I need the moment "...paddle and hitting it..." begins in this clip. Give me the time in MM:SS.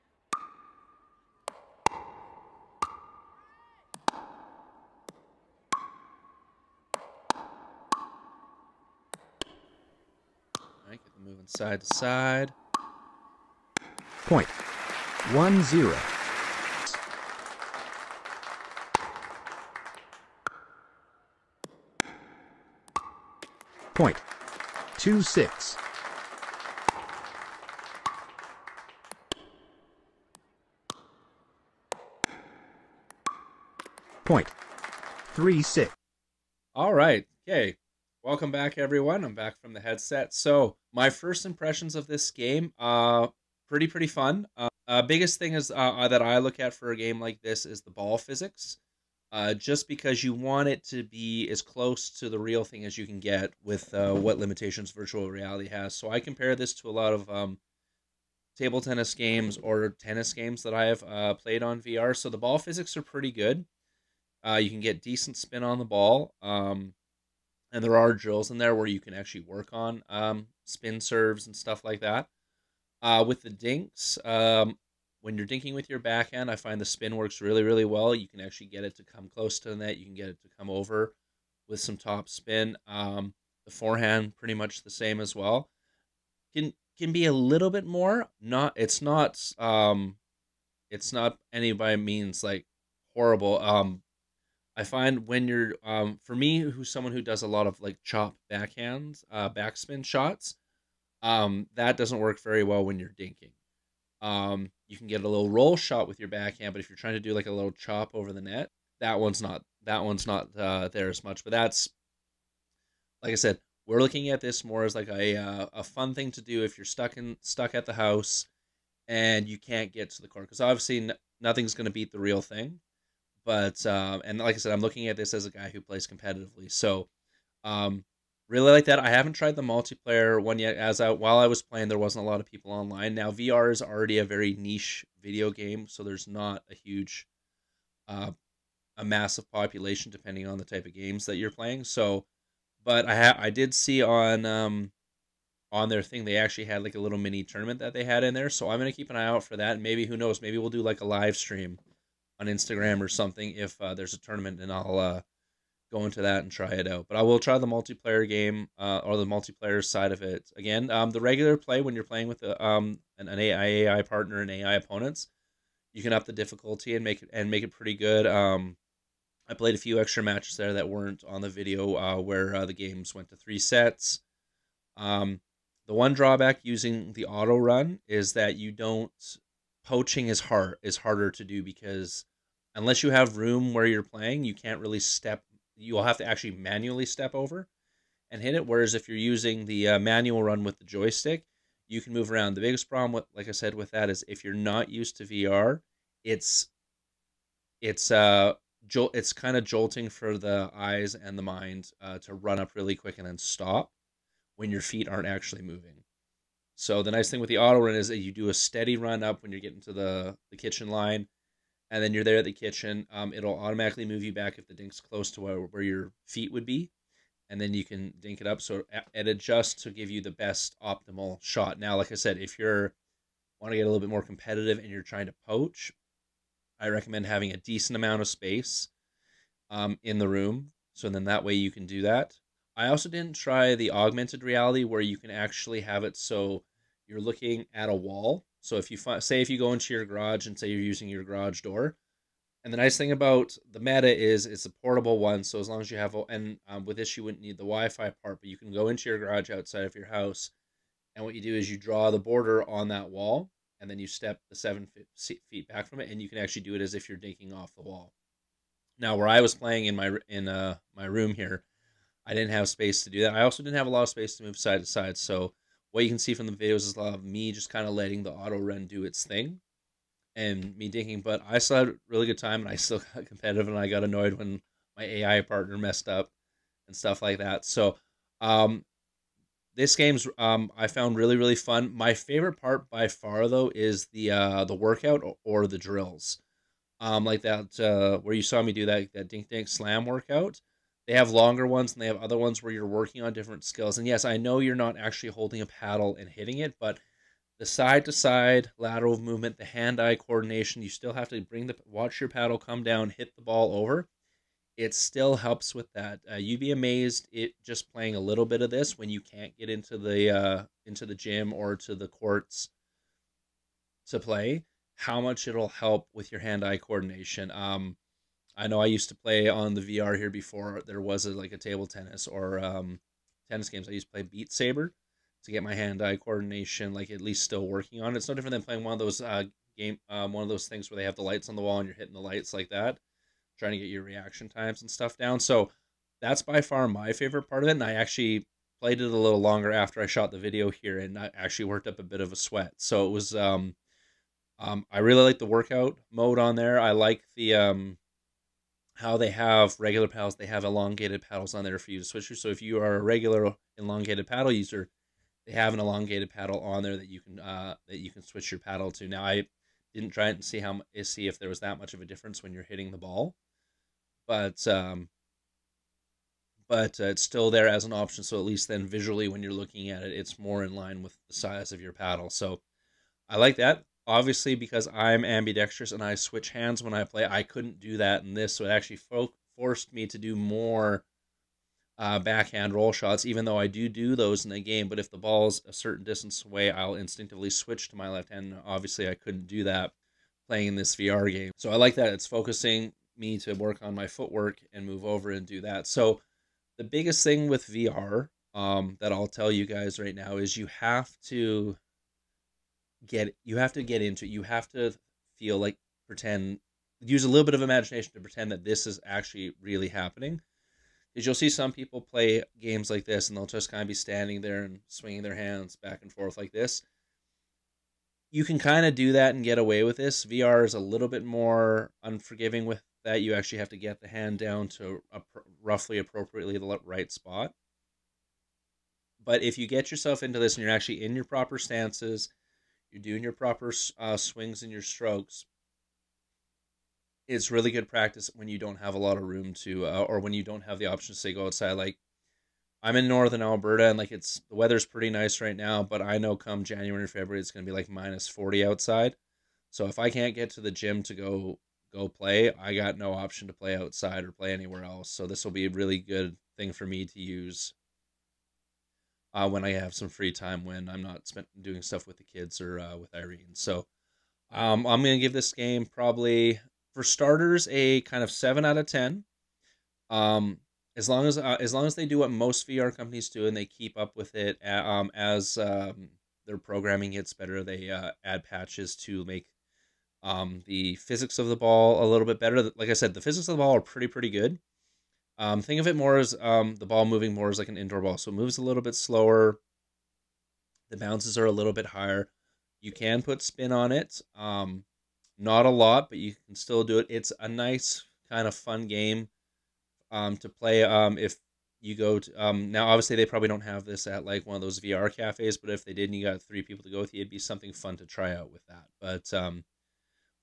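04:55.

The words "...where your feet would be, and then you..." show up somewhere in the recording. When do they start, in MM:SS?
03:35.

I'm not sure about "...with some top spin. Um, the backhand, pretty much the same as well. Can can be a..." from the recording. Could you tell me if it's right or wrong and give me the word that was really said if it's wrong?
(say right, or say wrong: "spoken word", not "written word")
wrong: "forehand", not "backhand".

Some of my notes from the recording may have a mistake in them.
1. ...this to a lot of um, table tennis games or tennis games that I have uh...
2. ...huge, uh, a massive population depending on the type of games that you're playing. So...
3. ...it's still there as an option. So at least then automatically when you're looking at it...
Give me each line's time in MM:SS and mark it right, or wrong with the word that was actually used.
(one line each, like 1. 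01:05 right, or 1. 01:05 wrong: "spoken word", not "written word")
1. 00:56 right
2. 02:16 right
3. 06:07 wrong: "visually", not "automatically".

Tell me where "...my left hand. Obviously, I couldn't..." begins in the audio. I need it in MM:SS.
06:27.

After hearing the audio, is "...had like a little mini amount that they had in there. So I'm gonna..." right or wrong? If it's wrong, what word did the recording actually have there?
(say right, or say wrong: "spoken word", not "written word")
wrong: "tournament", not "amount".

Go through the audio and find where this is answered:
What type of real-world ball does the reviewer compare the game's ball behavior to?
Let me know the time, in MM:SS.
08:07.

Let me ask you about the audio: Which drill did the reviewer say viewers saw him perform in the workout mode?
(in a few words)
Dink dink slam.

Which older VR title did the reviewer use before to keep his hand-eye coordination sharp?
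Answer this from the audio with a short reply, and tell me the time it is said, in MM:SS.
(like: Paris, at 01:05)
Beat Saber, at 05:24.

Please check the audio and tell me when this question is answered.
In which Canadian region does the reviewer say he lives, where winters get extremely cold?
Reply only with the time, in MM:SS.
07:23.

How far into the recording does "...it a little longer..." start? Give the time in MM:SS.
05:38.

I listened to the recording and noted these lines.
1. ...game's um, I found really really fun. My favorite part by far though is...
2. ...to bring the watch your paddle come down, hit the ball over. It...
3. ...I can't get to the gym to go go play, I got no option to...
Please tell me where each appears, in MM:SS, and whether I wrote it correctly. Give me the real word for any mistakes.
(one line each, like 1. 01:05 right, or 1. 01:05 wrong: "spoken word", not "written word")
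1. 04:39 right
2. 05:01 right
3. 07:29 right.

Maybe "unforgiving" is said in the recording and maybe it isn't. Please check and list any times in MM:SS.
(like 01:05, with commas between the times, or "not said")
07:02.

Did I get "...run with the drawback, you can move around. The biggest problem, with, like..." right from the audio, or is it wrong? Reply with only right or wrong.
wrong.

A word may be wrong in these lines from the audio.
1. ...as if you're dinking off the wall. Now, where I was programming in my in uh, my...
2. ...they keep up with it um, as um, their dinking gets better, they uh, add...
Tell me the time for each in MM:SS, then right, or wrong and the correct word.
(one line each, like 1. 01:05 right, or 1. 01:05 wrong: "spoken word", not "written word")
1. 04:16 wrong: "playing", not "programming"
2. 07:53 wrong: "programming", not "dinking".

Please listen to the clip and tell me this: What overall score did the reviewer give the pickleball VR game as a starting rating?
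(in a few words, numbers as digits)
7 out of 10.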